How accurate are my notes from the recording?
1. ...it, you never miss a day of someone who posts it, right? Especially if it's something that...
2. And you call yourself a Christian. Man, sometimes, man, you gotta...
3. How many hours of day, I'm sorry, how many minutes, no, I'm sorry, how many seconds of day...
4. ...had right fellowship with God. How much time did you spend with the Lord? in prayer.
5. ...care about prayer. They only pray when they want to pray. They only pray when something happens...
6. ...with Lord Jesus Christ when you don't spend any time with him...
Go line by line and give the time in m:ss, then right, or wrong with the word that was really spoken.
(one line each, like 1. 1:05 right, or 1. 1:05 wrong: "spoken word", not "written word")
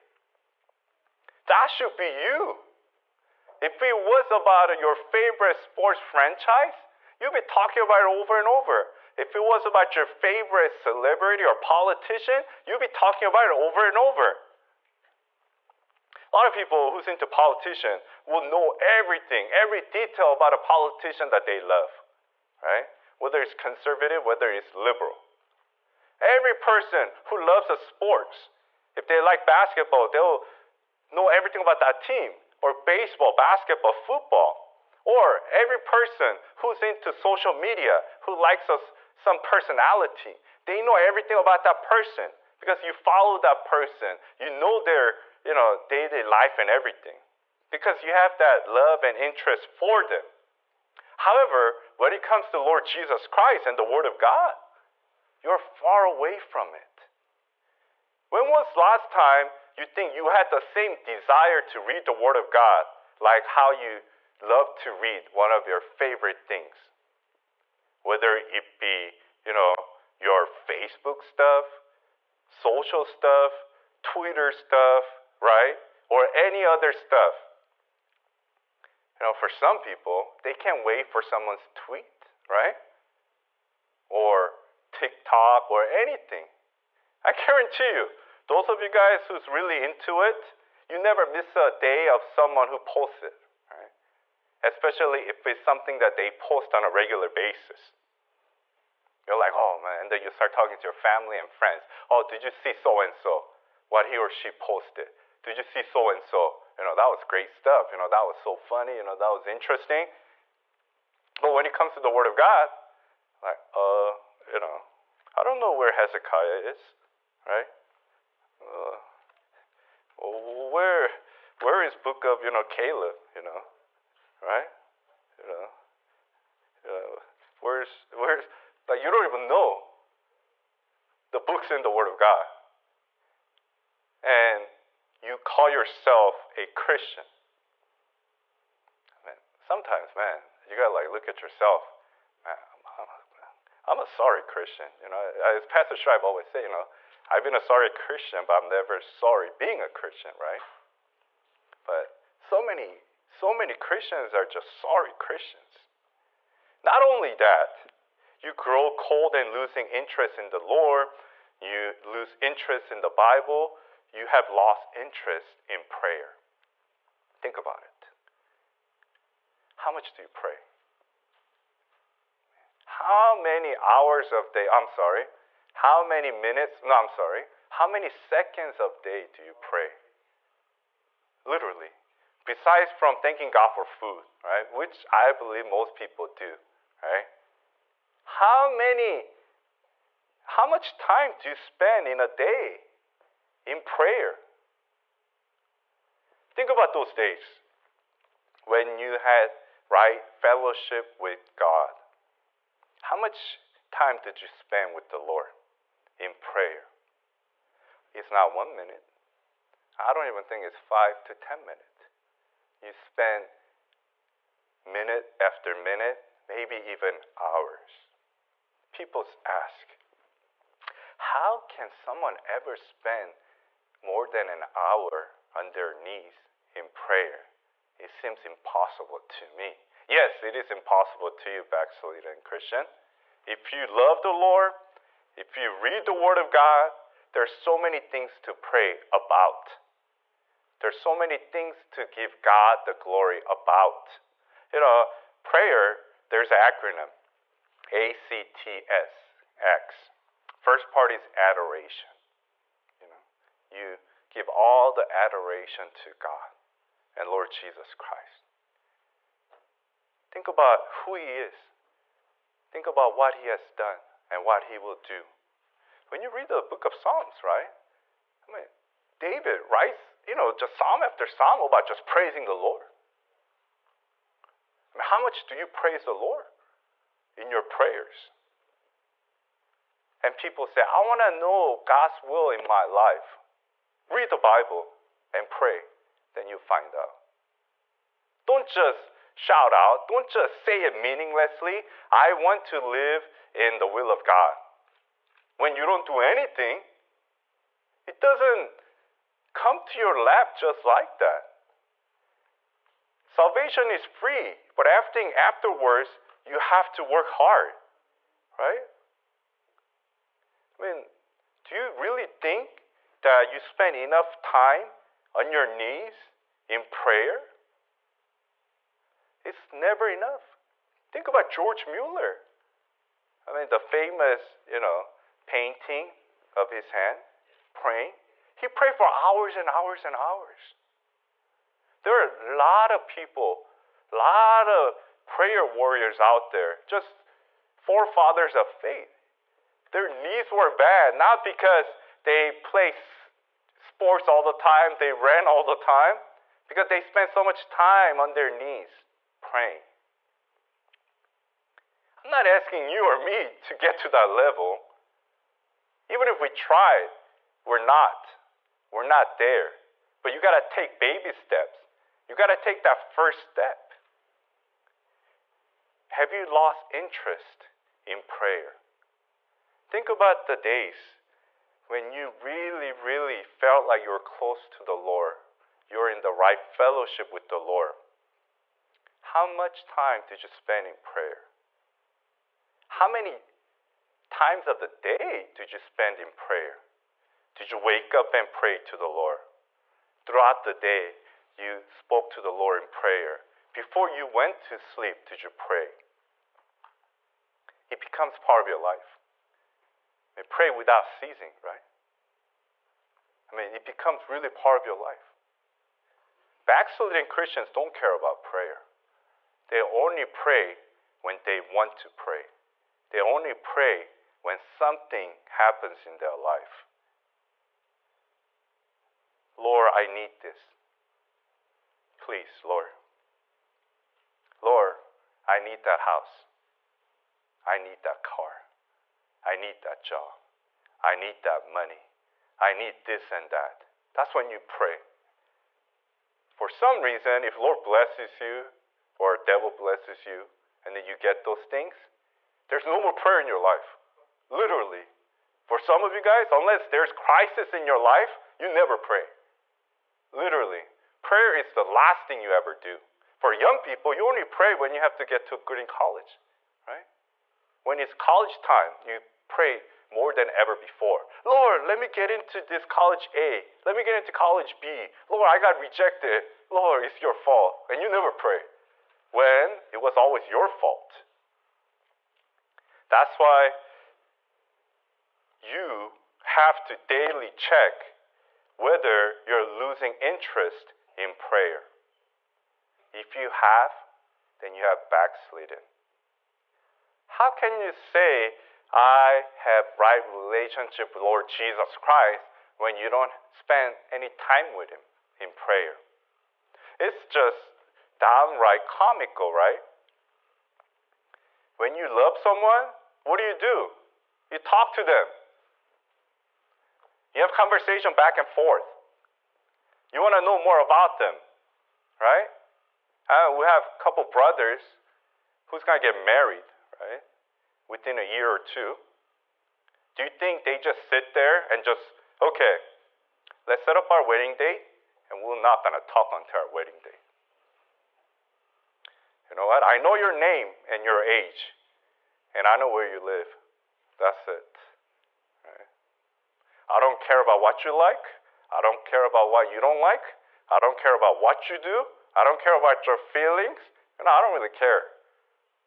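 1. 1:30 right
2. 2:14 right
3. 2:52 right
4. 3:19 right
5. 6:47 right
6. 8:11 right.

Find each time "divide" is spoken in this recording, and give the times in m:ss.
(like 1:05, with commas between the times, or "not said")
not said.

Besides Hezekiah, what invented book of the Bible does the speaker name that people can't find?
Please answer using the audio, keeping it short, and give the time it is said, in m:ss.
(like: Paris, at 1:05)
Caleb, at 2:02.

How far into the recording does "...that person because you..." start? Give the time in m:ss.
0:41.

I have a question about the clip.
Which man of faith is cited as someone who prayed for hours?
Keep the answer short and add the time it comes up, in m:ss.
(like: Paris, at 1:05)
George Mueller, at 5:21.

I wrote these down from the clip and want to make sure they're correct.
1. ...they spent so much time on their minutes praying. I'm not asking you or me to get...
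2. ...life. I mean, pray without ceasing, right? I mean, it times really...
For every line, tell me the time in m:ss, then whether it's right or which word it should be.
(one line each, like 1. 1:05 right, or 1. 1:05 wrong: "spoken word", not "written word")
1. 5:46 wrong: "knees", not "minutes"
2. 6:38 wrong: "becomes", not "times".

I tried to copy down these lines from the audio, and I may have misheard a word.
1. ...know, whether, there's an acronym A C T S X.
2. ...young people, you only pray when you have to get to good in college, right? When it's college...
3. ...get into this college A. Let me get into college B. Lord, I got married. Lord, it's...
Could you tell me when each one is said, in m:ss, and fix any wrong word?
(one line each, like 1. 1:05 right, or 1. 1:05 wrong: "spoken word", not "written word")
1. 4:04 wrong: "prayer", not "whether"
2. 7:33 right
3. 7:42 wrong: "rejected", not "married".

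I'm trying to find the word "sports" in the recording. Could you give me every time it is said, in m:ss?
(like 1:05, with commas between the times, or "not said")
0:05, 0:27, 5:42.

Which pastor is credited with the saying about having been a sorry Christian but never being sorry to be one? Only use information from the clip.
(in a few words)
Pastor Schreib.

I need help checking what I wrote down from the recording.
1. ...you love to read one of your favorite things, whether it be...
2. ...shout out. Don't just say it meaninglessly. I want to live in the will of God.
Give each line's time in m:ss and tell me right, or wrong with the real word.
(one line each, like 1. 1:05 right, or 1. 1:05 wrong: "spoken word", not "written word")
1. 1:03 right
2. 4:49 right.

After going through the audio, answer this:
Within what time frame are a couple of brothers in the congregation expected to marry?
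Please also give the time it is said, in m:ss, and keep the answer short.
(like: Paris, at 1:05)
A year or two, at 8:38.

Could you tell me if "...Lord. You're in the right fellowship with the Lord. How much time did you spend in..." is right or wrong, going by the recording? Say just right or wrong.
right.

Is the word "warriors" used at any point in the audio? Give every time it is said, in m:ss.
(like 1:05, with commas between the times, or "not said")
5:35.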